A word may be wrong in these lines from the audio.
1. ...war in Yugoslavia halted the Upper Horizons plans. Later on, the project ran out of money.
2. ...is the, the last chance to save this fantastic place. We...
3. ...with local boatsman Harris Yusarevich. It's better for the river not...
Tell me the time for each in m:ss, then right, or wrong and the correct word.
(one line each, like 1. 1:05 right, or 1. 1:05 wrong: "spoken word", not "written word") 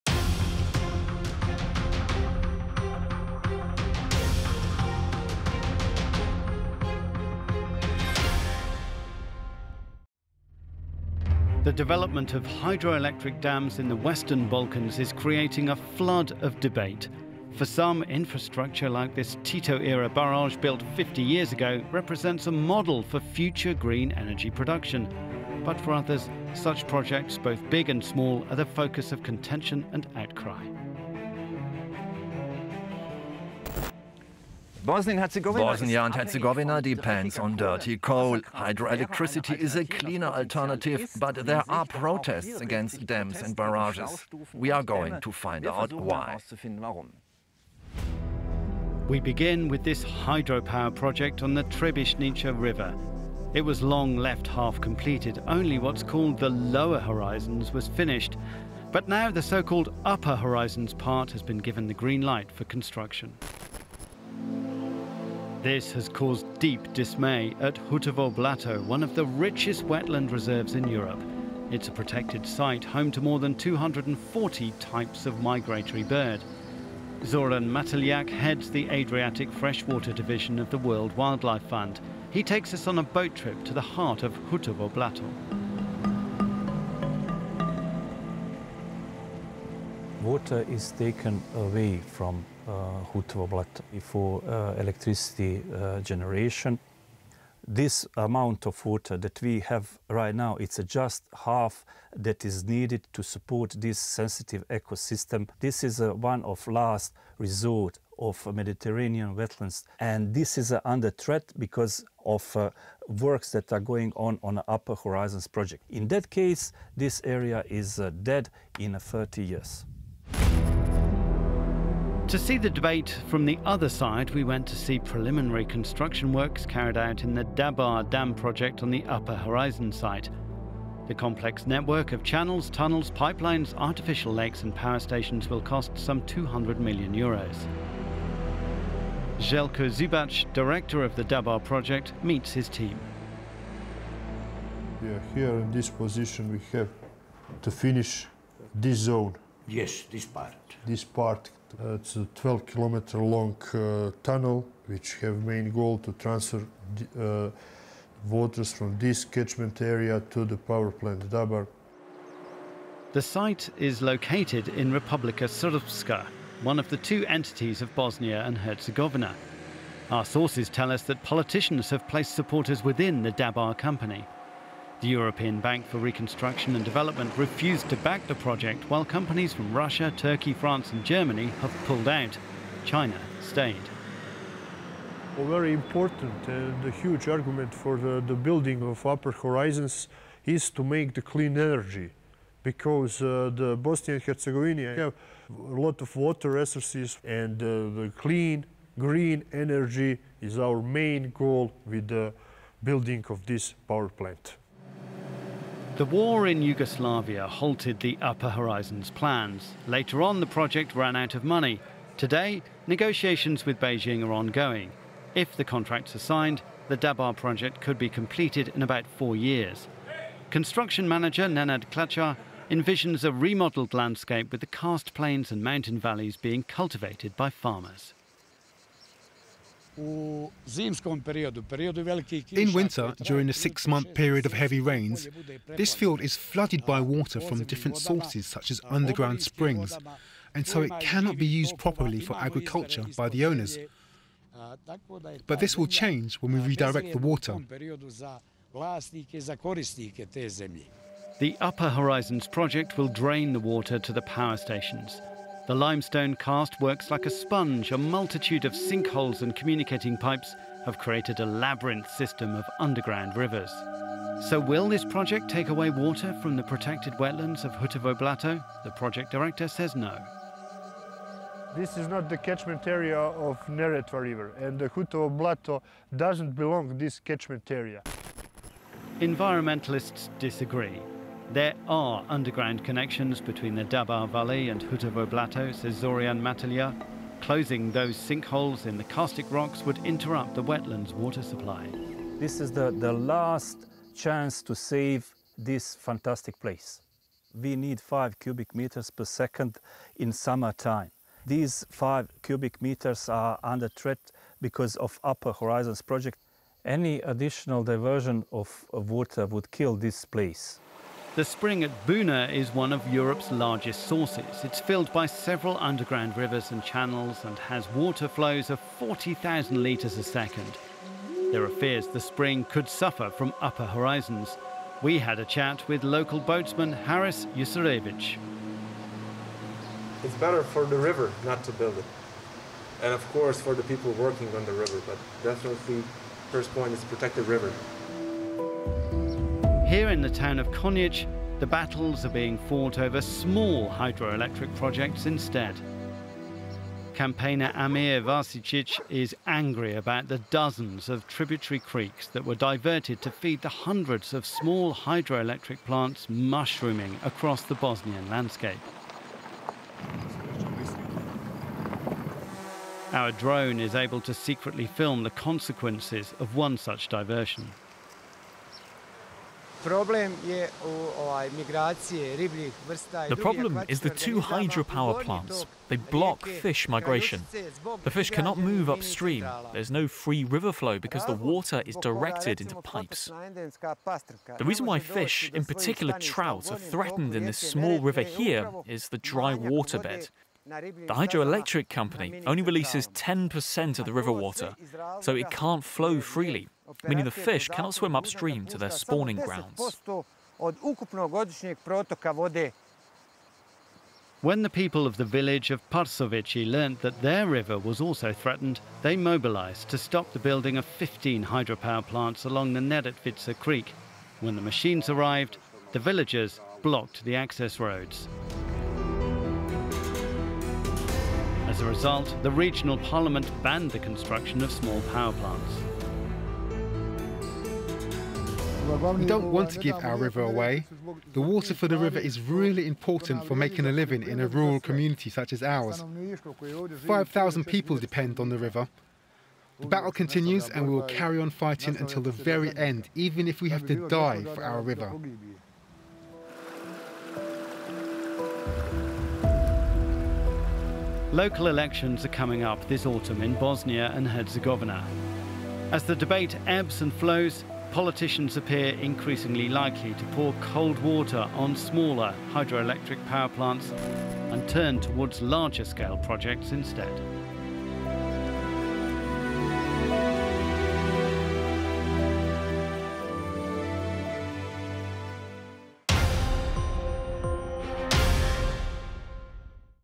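1. 3:26 right
2. 4:52 right
3. 5:25 right.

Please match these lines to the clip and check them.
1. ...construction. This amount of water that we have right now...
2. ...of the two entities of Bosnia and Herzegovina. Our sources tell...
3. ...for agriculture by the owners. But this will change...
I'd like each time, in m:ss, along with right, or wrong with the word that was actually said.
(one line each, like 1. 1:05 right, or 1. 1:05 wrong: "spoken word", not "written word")
1. 1:36 wrong: "generation", not "construction"
2. 2:46 right
3. 4:02 right.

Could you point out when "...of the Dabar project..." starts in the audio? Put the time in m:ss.
2:21.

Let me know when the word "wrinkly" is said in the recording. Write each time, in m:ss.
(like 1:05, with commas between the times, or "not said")
not said.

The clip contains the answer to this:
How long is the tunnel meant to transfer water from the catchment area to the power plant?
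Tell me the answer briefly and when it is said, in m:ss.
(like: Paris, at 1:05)
12 kilometers, at 2:32.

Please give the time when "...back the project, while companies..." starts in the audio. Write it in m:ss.
2:58.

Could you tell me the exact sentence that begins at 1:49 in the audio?
And this is under threat because of uh, works that are going on on Upper Horizons project.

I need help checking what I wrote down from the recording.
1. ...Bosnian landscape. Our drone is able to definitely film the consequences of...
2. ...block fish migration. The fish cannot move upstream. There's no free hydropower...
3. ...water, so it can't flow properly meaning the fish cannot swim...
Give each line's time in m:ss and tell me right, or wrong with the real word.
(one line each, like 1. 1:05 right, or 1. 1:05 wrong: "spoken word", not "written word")
1. 5:57 wrong: "secretly", not "definitely"
2. 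6:15 wrong: "river", not "hydropower"
3. 6:34 wrong: "freely", not "properly".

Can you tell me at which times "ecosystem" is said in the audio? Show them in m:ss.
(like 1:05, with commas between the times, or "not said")
1:44.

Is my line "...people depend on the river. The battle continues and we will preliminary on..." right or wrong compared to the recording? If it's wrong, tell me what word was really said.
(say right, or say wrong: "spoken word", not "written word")
wrong: "carry", not "preliminary".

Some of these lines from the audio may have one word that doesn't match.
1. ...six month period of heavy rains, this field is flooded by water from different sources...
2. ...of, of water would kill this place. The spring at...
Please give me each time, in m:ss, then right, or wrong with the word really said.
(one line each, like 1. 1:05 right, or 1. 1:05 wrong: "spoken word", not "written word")
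1. 3:53 right
2. 5:08 right.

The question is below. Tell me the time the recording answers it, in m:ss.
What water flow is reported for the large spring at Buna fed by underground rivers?
5:18.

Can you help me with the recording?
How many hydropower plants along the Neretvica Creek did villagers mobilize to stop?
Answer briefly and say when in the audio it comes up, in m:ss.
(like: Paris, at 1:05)
15, at 6:50.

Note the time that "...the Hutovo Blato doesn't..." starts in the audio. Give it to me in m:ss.
4:34.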